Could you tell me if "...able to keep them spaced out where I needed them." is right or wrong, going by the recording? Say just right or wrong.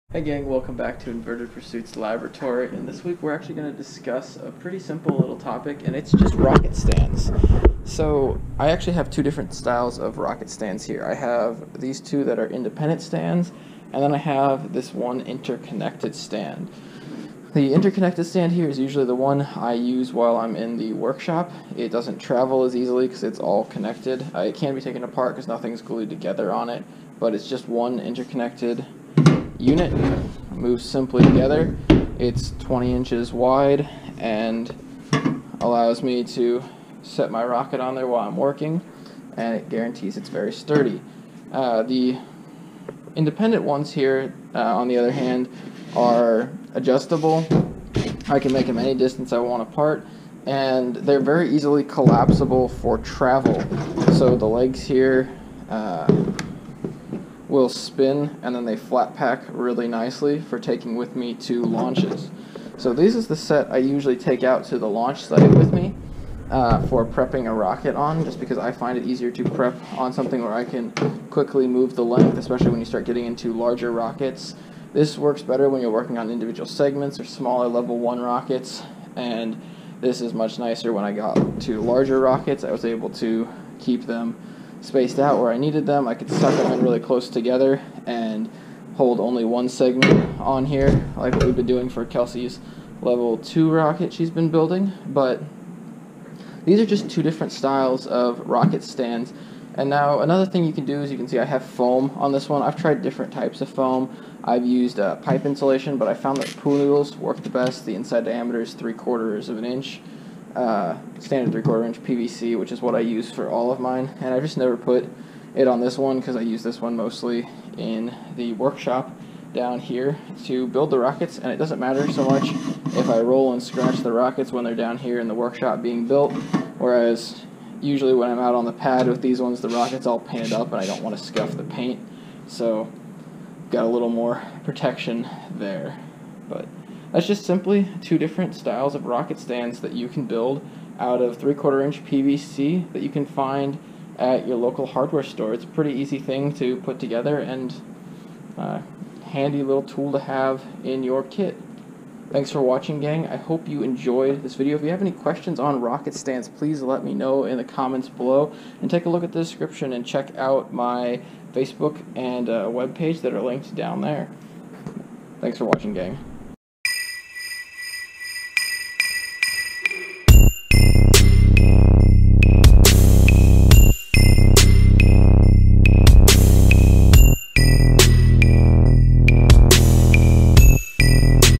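right.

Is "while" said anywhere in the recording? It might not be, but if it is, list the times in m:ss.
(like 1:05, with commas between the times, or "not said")
0:20, 0:38.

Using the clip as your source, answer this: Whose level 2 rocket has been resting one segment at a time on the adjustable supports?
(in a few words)
Kelsey.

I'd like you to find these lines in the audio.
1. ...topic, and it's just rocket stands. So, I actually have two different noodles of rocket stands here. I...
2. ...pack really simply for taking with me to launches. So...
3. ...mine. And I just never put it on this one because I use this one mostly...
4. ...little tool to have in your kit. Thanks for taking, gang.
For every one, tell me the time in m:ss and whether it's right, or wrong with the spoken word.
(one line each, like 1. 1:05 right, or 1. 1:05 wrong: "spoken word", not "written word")
1. 0:05 wrong: "styles", not "noodles"
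2. 0:59 wrong: "nicely", not "simply"
3. 1:53 right
4. 2:29 wrong: "watching", not "taking".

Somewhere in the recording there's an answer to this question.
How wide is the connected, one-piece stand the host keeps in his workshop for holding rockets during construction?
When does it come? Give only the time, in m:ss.
0:32.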